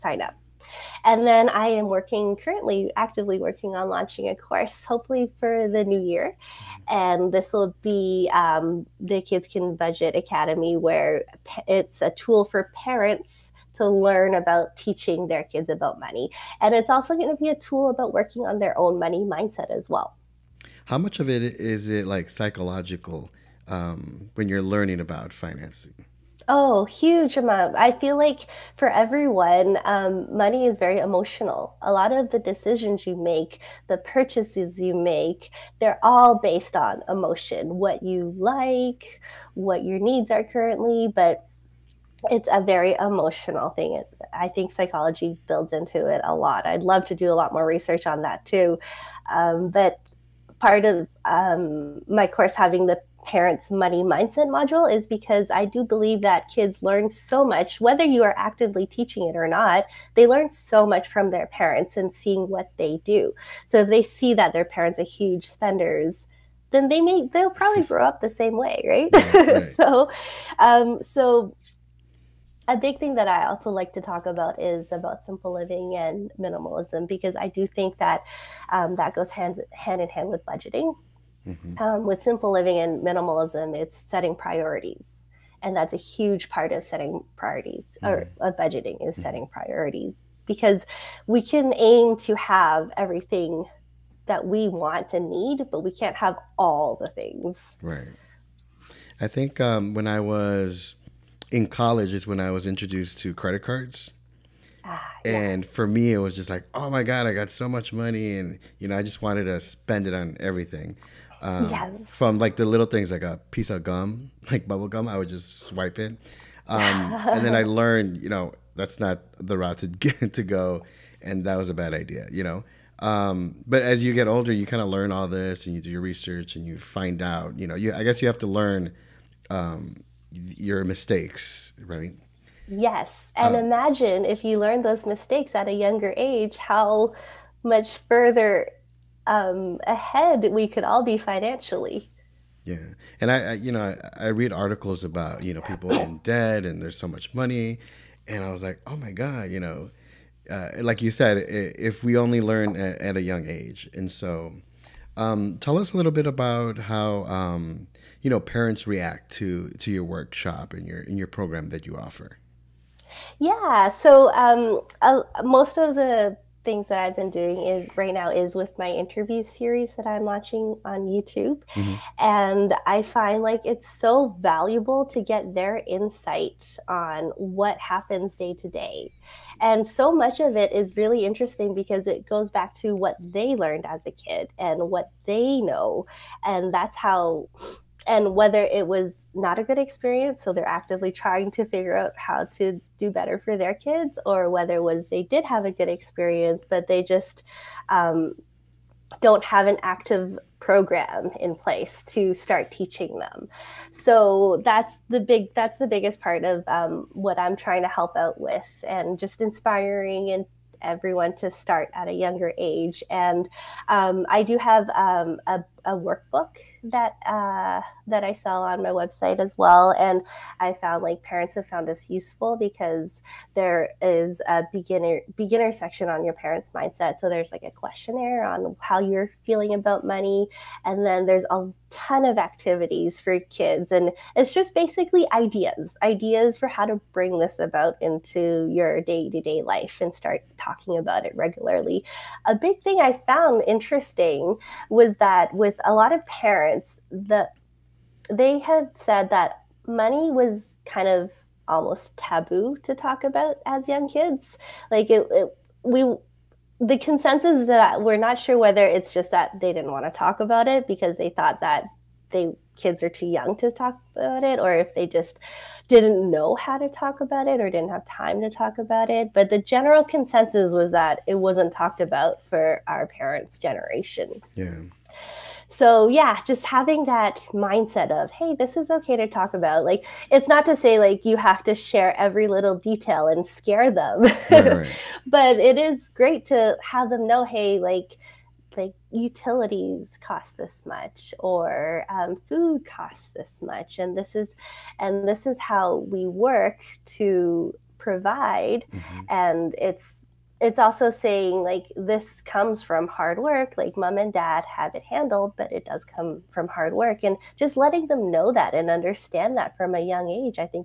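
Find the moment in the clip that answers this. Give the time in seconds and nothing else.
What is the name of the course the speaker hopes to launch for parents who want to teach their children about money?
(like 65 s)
9 s.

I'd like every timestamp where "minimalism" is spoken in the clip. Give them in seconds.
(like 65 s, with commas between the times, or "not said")
76 s, 83 s.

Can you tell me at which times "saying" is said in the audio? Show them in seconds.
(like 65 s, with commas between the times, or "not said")
301 s.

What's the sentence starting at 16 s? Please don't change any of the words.
And it's also going to be a tool about working on their own money mindset as well.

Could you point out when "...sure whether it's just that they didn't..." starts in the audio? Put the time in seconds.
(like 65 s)
258 s.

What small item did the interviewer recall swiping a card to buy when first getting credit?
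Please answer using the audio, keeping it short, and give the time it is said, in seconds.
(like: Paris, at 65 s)
bubble gum, at 114 s.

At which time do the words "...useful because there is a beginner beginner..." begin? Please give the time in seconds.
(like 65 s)
222 s.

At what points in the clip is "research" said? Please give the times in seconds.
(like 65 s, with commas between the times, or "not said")
47 s, 126 s.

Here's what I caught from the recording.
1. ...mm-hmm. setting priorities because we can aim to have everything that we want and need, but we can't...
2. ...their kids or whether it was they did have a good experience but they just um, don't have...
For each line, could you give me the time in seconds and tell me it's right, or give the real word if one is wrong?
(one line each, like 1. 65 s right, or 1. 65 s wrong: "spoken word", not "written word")
1. 89 s right
2. 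193 s right.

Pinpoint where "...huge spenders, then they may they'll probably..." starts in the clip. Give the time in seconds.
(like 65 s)
65 s.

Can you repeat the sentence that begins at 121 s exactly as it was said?
And that was a bad idea, you know?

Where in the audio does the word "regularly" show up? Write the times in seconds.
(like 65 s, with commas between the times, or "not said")
241 s.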